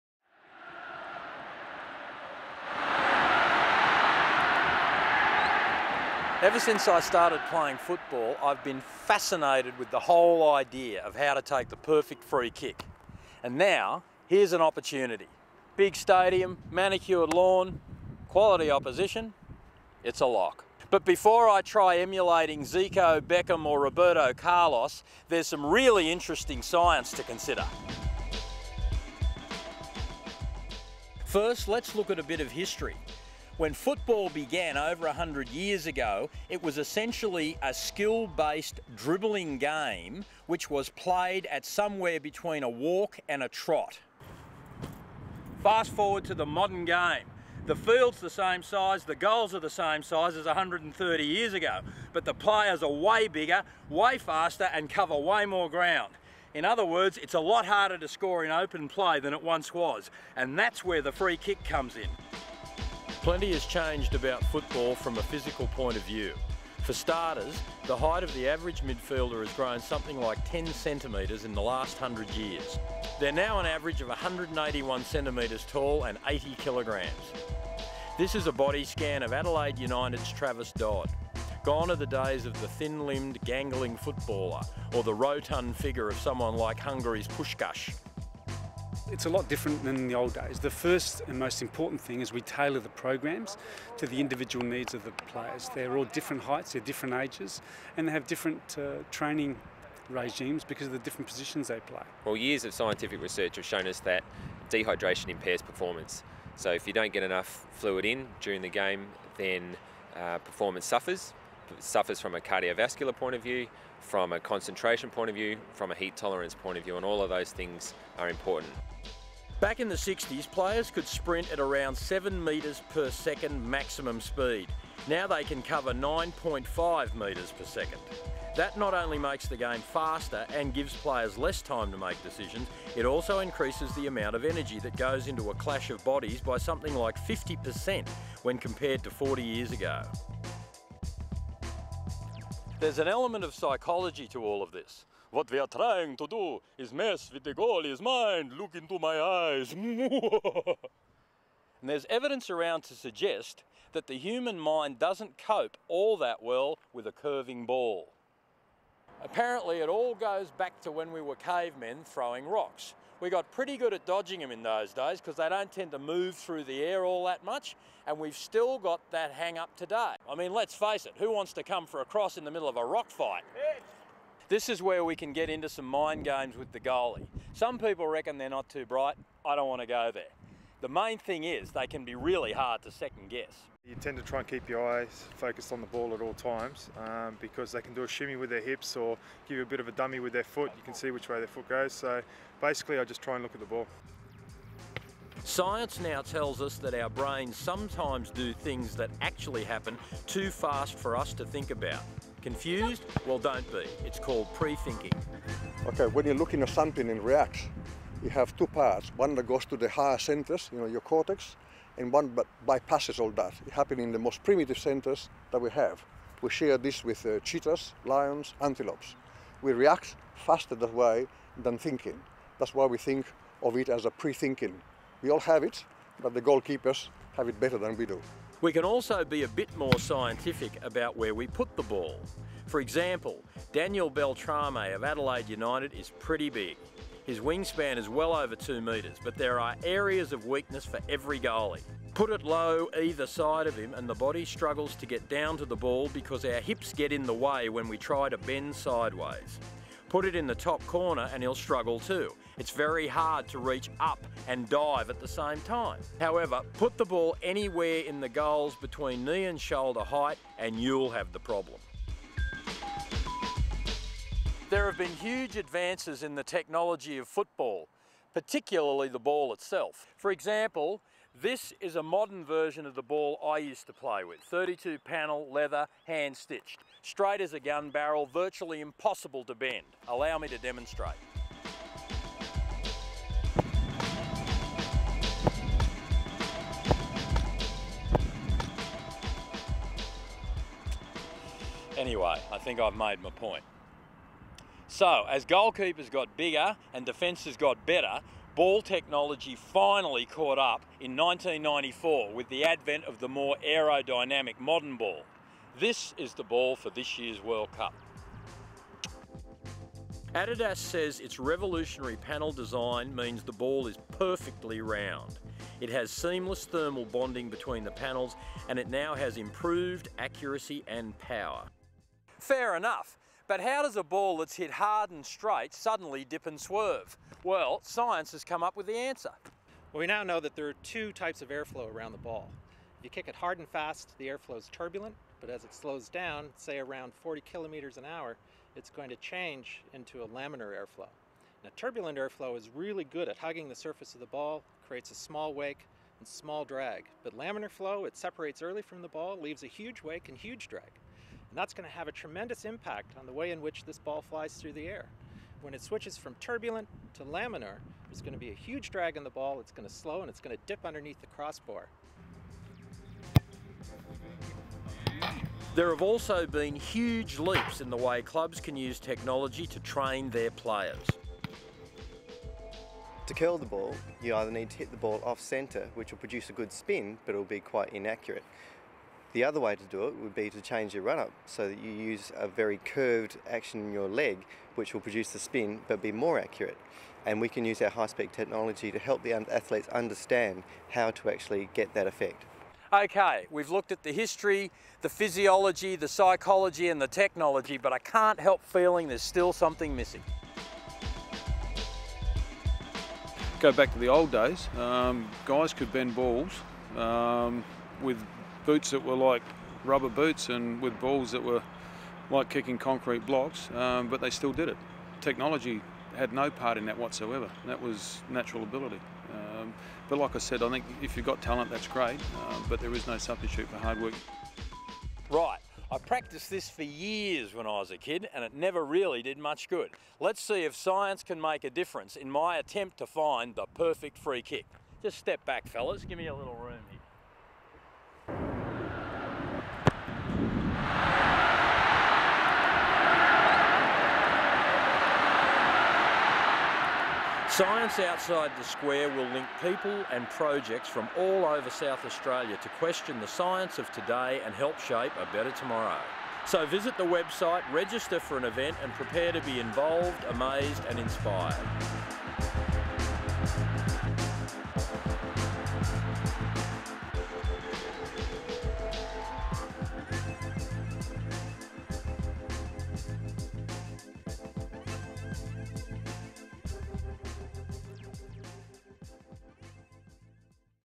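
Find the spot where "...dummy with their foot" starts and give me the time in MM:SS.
03:09.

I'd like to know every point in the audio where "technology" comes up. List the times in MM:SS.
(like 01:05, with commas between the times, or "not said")
04:26, 04:58, 06:08, 06:28, 06:37, 06:55.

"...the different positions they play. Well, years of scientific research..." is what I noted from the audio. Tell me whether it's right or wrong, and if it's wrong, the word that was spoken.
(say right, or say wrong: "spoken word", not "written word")
right.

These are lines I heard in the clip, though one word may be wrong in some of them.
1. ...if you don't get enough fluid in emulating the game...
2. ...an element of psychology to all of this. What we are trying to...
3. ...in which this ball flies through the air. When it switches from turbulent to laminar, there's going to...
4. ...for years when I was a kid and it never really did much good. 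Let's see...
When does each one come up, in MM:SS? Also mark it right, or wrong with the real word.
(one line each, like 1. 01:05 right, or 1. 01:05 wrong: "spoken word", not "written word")
1. 01:46 wrong: "during", not "emulating"
2. 02:22 right
3. 05:53 right
4. 07:06 right.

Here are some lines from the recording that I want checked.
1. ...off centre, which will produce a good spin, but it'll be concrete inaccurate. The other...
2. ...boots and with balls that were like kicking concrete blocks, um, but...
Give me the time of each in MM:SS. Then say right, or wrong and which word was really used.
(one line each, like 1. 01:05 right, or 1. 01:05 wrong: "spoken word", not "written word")
1. 06:15 wrong: "quite", not "concrete"
2. 06:50 right.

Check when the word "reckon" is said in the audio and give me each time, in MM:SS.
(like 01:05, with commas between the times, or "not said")
02:58.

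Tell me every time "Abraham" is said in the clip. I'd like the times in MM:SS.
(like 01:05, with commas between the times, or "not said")
not said.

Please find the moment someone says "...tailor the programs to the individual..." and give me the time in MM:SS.
01:32.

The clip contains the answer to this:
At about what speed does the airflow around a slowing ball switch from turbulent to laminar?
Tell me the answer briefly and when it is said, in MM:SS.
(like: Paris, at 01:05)
40 km/h, at 05:37.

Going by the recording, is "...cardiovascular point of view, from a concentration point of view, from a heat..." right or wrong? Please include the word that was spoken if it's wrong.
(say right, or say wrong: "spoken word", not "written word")
right.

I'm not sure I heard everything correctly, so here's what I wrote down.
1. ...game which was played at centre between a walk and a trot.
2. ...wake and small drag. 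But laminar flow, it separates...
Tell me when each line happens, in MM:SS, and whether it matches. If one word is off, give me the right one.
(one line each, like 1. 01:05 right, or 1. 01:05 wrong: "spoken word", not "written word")
1. 00:39 wrong: "somewhere", not "centre"
2. 05:45 right.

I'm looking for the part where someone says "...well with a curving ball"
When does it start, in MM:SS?
02:36.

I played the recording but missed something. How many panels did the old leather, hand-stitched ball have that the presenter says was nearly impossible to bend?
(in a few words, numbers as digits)
32.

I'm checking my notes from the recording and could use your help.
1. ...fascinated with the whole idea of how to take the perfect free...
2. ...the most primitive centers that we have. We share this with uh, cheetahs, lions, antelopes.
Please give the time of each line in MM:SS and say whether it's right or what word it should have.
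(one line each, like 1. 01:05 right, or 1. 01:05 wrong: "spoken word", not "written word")
1. 00:08 right
2. 03:34 right.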